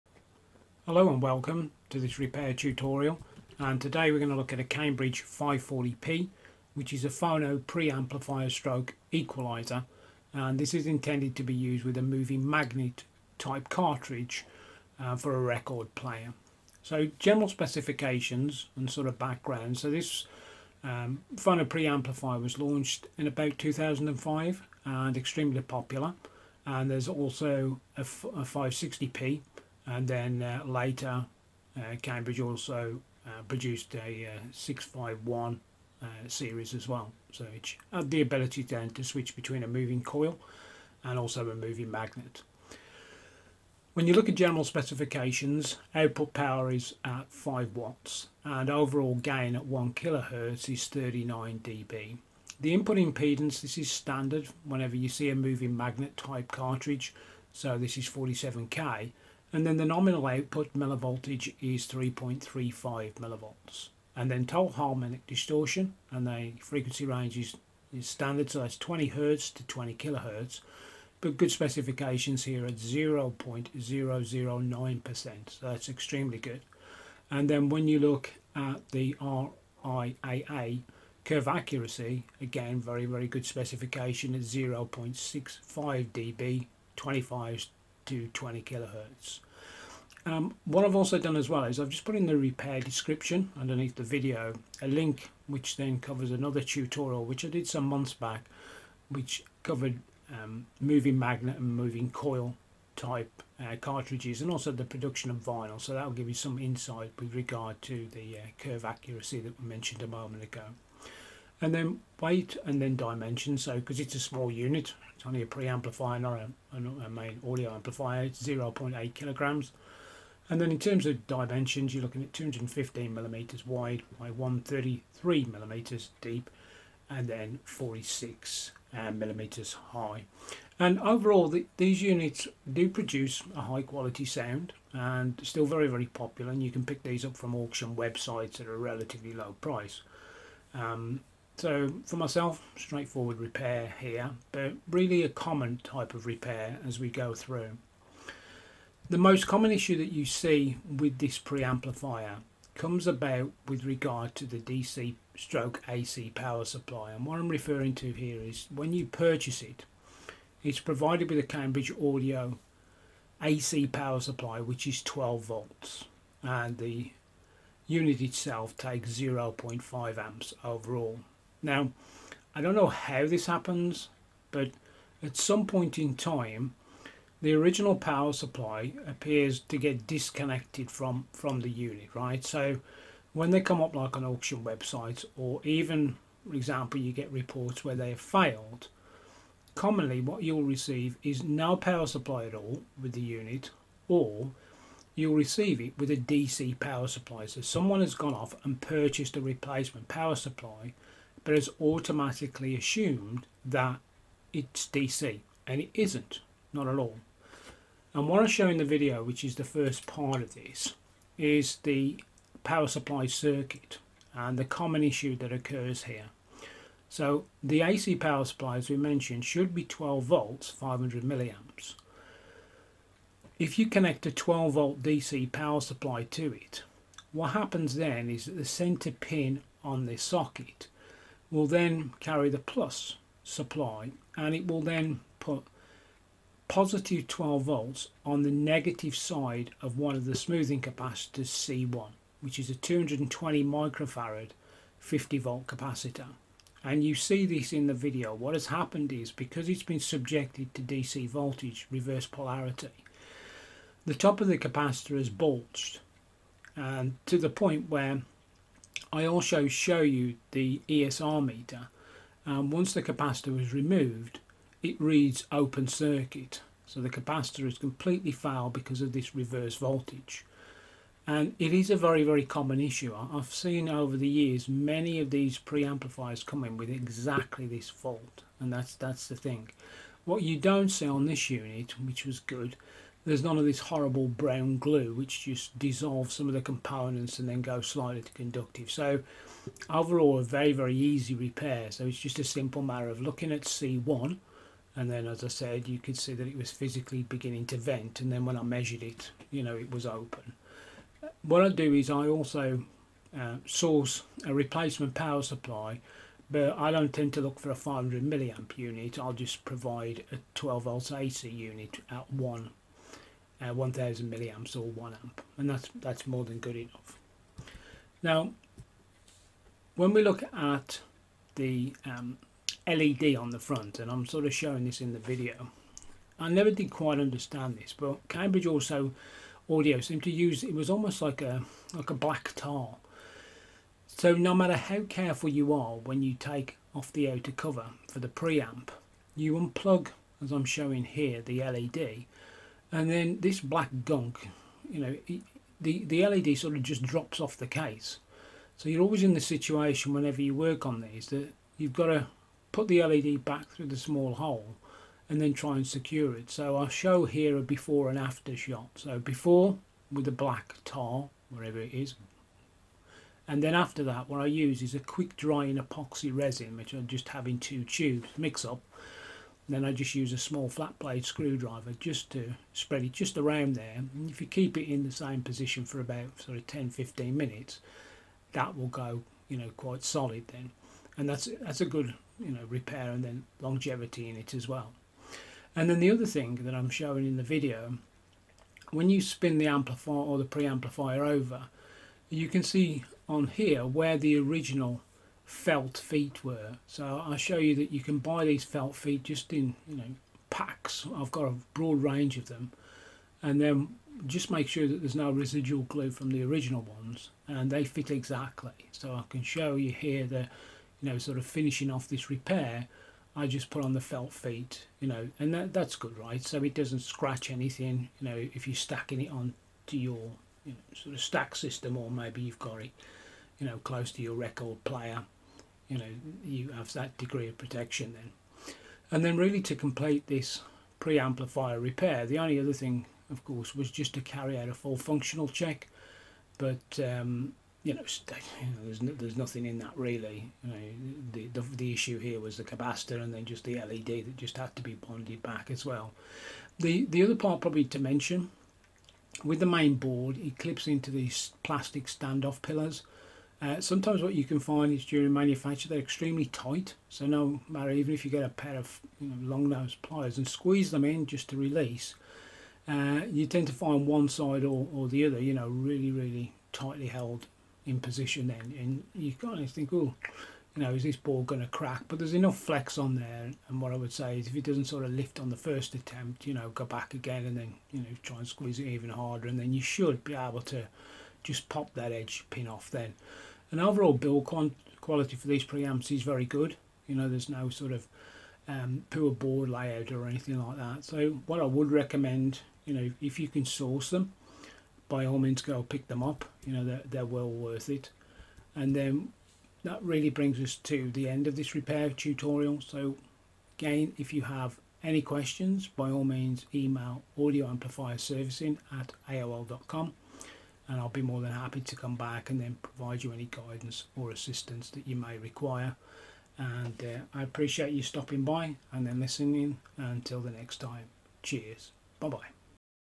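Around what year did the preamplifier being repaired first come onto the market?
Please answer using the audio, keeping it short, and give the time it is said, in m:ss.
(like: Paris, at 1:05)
2005, at 0:23.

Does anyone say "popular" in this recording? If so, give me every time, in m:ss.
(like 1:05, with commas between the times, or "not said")
0:25, 2:16.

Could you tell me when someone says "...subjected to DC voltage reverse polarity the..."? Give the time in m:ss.
4:09.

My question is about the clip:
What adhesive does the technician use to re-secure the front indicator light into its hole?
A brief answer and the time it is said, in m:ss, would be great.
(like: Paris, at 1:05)
quick drying epoxy resin, at 6:04.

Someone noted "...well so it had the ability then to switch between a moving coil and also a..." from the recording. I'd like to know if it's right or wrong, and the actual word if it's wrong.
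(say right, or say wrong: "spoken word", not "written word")
right.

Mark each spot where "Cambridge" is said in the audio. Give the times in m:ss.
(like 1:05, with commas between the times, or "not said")
0:04, 0:32, 2:41, 5:28.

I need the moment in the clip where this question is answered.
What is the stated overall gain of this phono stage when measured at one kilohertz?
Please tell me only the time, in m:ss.
0:50.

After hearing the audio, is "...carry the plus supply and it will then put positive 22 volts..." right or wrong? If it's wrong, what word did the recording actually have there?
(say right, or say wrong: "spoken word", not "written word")
wrong: "12", not "22".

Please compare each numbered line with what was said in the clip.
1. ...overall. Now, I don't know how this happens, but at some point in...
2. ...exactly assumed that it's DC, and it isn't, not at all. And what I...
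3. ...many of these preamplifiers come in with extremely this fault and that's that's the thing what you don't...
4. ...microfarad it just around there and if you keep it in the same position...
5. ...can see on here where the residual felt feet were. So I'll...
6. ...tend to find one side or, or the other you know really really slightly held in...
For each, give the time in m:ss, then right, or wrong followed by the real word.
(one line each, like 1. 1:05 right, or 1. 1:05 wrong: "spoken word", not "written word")
1. 2:50 right
2. 3:21 wrong: "automatically", not "exactly"
3. 4:34 wrong: "exactly", not "extremely"
4. 6:12 wrong: "spread", not "microfarad"
5. 6:32 wrong: "original", not "residual"
6. 7:43 wrong: "tightly", not "slightly".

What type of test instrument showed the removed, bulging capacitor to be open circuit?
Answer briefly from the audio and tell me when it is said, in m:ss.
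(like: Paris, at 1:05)
ESR meter, at 4:20.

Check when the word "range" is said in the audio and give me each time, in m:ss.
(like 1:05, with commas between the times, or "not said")
1:07, 6:42.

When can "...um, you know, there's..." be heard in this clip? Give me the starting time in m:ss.
7:17.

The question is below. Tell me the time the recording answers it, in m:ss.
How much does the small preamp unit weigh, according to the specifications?
1:58.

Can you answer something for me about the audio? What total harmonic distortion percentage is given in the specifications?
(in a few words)
0.009%.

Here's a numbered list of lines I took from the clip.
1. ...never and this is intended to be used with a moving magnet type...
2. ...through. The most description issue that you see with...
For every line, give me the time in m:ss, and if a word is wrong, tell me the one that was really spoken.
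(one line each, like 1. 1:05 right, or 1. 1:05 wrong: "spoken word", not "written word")
1. 0:09 wrong: "equalizer", not "never"
2. 2:27 wrong: "common", not "description".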